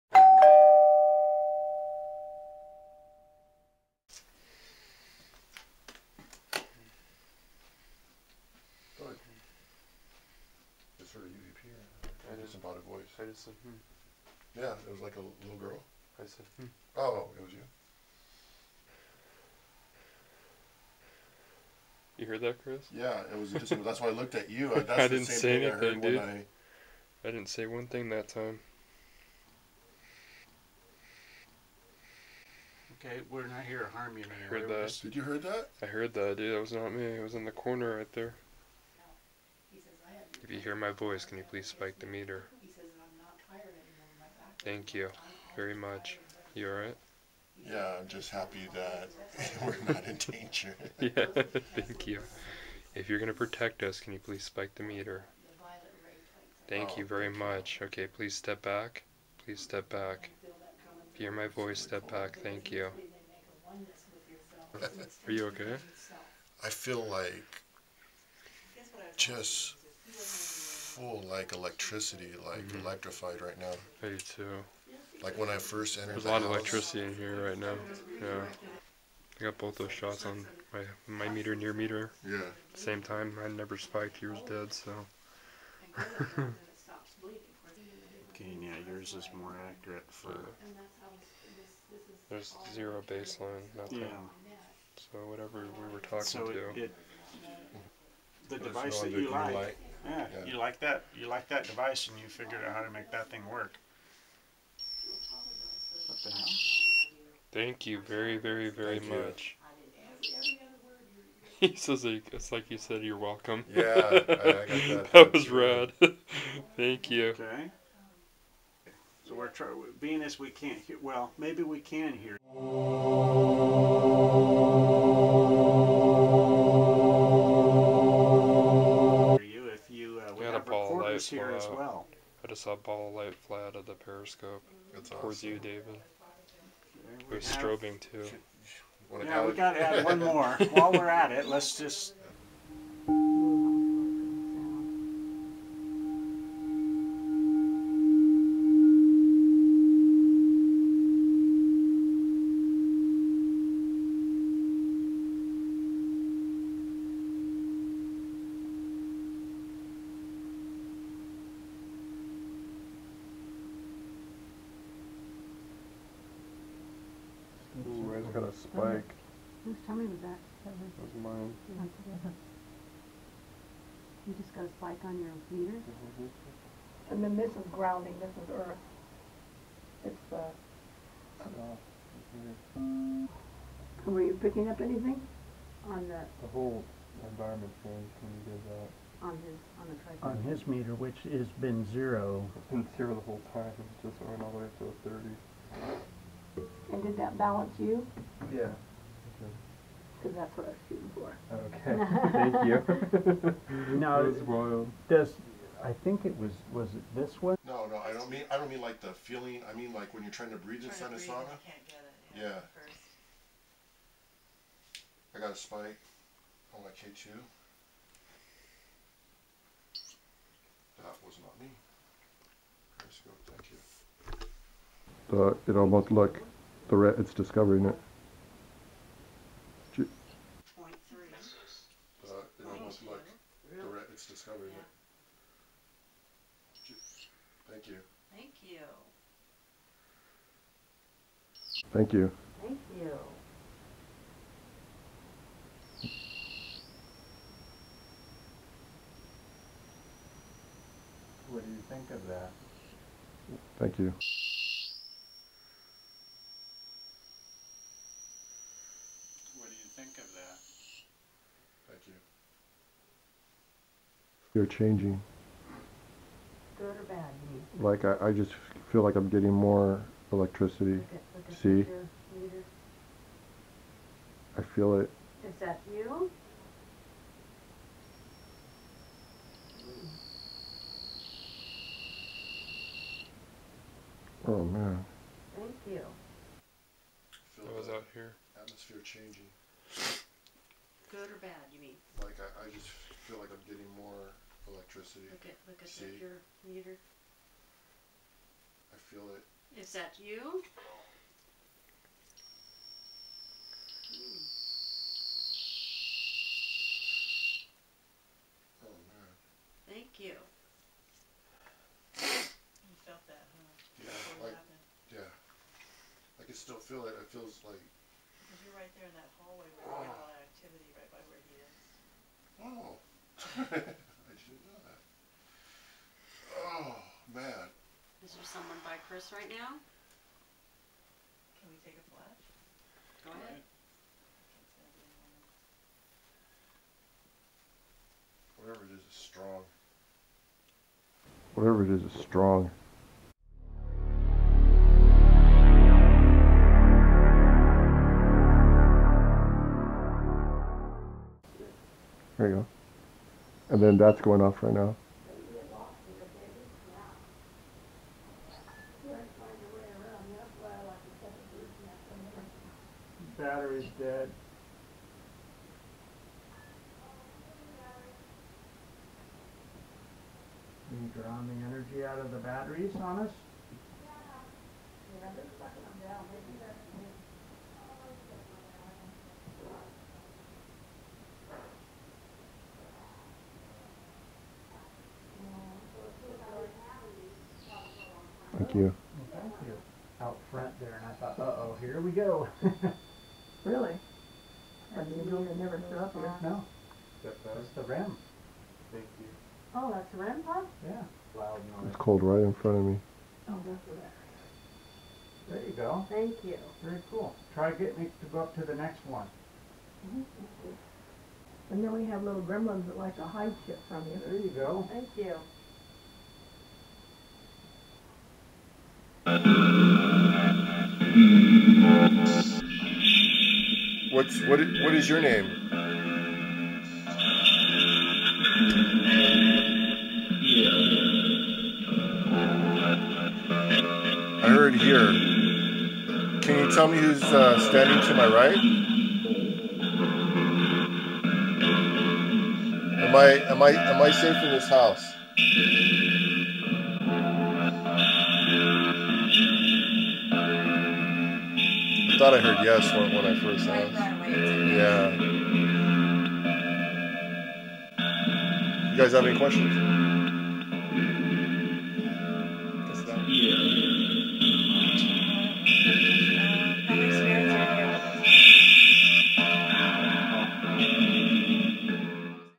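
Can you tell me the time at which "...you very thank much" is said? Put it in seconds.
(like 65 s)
56 s.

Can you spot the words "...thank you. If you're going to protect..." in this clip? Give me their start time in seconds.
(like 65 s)
51 s.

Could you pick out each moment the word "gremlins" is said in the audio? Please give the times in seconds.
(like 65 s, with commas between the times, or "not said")
412 s.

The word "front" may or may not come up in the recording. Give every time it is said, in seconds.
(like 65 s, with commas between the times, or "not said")
390 s, 402 s.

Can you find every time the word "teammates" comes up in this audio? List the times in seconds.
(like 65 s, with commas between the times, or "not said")
not said.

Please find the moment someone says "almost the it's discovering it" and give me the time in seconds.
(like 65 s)
232 s.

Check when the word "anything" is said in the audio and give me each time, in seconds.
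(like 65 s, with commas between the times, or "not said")
25 s, 184 s.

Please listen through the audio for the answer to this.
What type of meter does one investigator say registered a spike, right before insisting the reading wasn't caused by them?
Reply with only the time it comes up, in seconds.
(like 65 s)
216 s.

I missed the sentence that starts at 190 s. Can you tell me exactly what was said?
On his meter, which has been zero.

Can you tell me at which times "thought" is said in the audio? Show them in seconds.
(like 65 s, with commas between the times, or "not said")
391 s, 452 s.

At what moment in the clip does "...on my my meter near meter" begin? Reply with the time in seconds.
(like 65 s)
80 s.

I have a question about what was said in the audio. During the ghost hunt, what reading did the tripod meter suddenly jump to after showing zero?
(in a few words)
30.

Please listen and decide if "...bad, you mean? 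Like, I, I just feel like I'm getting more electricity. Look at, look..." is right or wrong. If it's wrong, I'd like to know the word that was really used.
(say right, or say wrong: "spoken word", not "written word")
right.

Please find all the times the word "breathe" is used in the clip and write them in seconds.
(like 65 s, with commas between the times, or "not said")
210 s.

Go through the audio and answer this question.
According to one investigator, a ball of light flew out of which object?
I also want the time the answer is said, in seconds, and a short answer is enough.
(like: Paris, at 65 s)
the periscope, at 133 s.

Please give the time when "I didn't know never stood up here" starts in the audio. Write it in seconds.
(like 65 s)
394 s.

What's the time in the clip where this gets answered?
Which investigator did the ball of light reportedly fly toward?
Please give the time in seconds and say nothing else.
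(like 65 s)
135 s.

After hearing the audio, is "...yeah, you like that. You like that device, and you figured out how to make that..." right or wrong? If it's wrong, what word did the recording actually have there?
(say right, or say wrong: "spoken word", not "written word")
right.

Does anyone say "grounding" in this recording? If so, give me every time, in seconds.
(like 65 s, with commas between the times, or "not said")
177 s.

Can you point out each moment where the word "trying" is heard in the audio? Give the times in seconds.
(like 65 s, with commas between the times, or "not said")
119 s, 210 s.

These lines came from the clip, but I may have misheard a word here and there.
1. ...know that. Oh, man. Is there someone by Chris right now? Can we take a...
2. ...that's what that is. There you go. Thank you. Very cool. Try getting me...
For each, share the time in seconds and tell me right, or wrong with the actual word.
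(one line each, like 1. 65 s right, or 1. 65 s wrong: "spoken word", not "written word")
1. 324 s right
2. 403 s right.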